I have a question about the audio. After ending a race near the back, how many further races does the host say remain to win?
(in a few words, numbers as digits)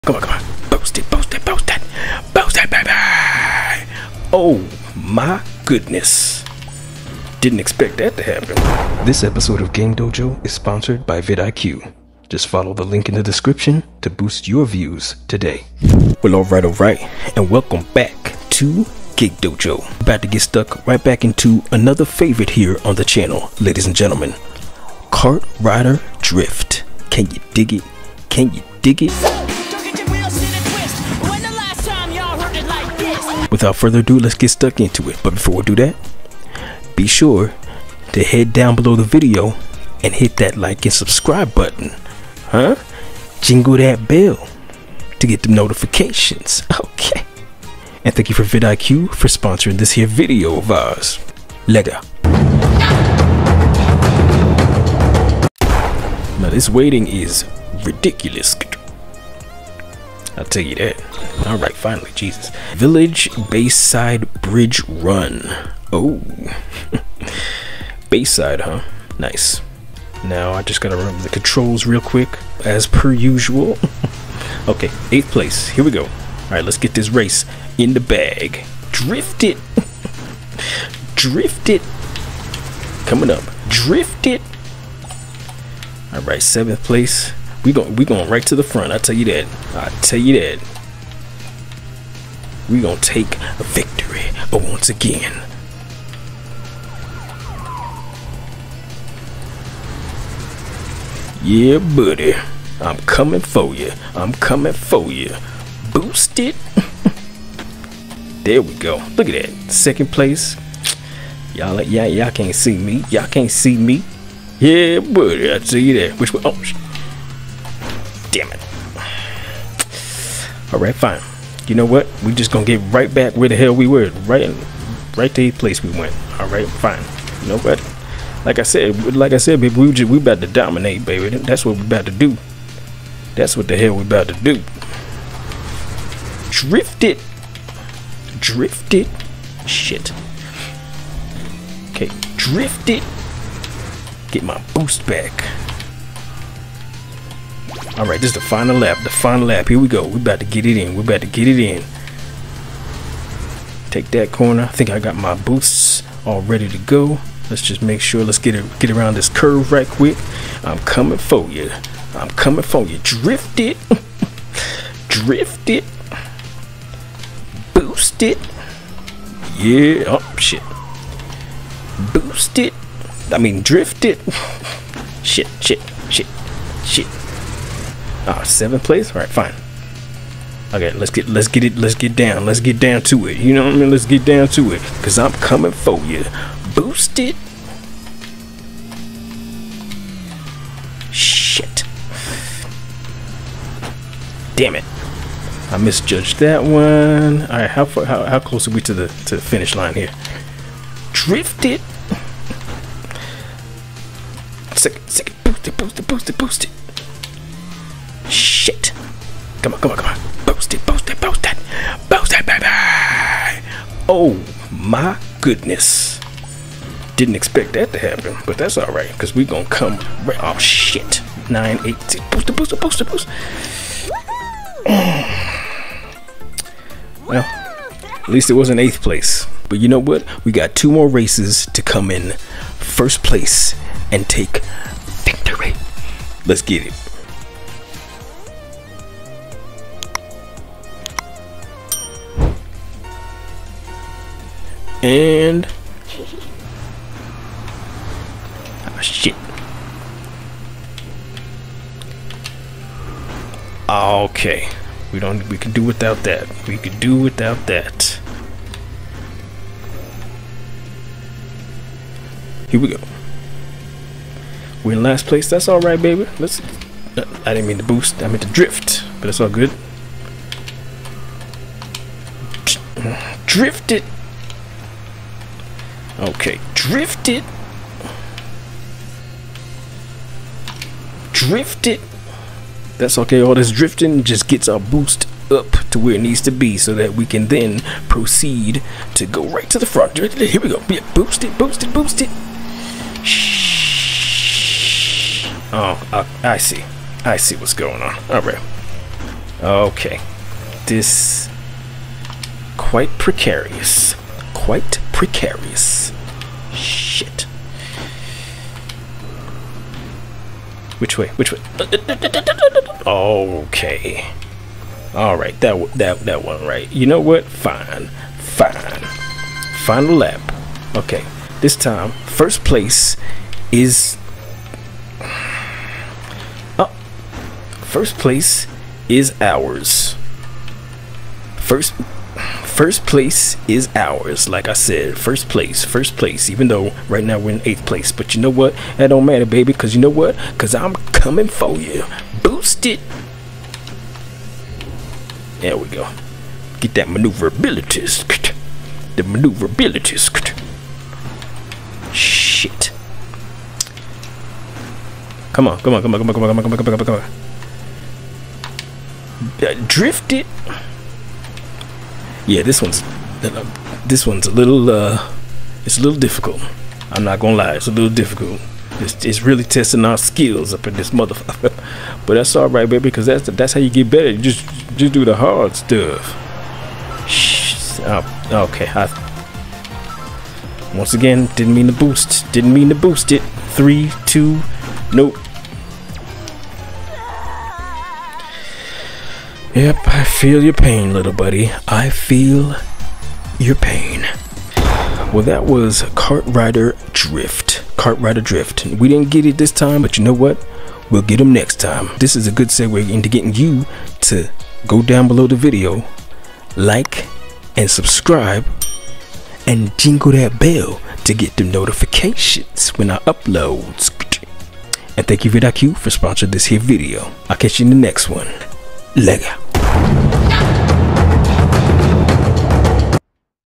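2.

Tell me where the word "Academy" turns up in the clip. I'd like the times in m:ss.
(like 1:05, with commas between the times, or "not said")
not said.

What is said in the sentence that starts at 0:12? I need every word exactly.
Just follow the link in the description to boost your views today.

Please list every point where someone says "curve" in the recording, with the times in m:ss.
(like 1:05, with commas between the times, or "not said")
2:39.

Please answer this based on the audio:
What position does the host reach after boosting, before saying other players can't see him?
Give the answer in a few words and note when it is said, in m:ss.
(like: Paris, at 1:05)
Second place, at 1:49.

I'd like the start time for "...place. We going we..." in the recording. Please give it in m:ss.
1:26.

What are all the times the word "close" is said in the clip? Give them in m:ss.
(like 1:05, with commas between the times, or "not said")
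3:18.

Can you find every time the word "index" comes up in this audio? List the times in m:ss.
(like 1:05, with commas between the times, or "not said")
not said.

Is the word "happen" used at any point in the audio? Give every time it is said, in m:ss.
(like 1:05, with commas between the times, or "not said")
0:08, 3:37.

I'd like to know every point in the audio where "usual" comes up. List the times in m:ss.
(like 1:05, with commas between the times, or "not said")
1:13.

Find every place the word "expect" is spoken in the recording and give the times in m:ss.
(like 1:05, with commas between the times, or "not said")
0:07, 3:37.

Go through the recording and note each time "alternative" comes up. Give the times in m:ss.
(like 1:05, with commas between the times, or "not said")
not said.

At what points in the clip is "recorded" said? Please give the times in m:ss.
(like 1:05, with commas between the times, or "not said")
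not said.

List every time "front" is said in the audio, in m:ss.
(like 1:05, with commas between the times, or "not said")
1:28, 4:49.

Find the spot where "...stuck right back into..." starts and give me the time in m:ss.
0:20.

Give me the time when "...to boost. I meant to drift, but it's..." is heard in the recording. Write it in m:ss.
4:27.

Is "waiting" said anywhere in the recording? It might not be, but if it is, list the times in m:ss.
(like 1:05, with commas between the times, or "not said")
0:56.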